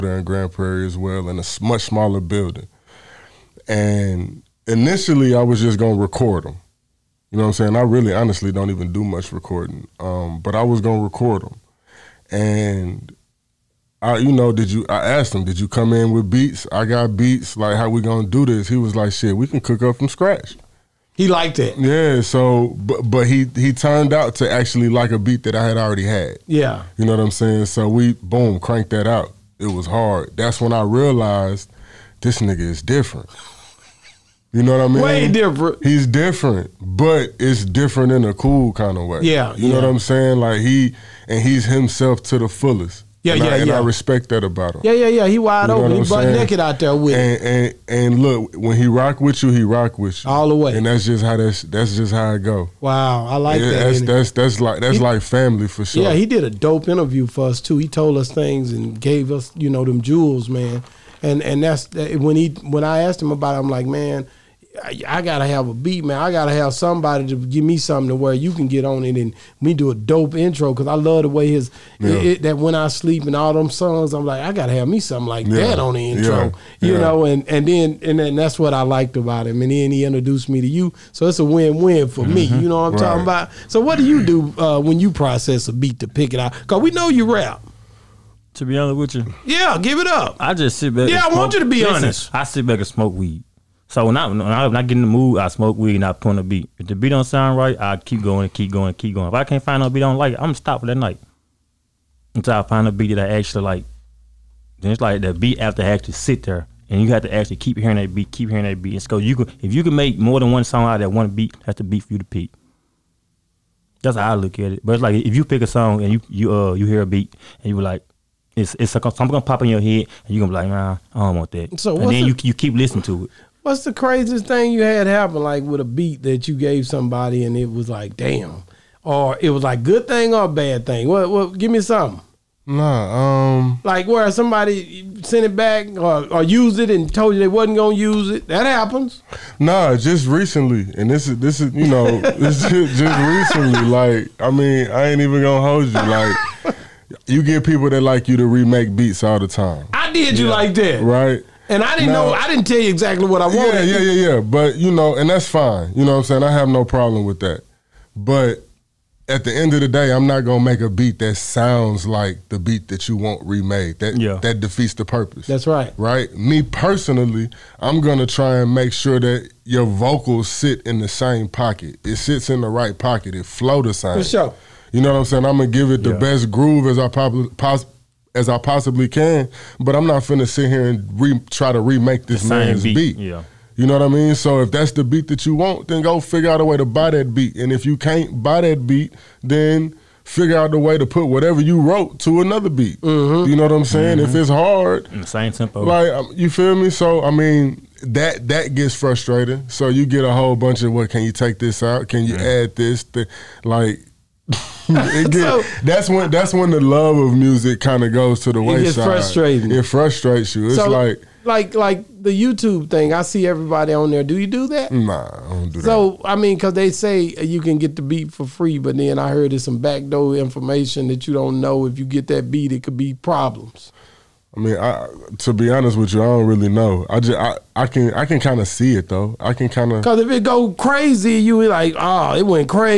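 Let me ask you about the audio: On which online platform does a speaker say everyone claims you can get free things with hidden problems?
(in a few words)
YouTube.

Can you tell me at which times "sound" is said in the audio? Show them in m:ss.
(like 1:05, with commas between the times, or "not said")
1:37, 2:41.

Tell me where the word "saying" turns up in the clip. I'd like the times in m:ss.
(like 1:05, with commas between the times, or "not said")
0:07, 0:27, 0:39, 2:36, 2:55, 3:13.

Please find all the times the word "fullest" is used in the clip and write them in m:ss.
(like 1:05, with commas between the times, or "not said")
0:42.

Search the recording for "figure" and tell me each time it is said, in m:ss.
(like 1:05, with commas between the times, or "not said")
3:06, 3:10.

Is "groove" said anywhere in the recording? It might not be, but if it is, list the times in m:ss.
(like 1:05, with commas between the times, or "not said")
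2:56.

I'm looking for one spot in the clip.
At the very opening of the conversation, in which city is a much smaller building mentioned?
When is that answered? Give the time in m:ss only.
0:00.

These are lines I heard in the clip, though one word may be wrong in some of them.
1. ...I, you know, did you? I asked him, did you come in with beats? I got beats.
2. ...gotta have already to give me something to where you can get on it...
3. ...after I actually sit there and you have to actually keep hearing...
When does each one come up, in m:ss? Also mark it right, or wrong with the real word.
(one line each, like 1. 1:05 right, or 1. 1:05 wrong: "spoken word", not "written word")
1. 0:14 right
2. 1:06 wrong: "somebody", not "already"
3. 1:45 right.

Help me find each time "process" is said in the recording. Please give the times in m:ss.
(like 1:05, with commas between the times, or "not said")
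1:25.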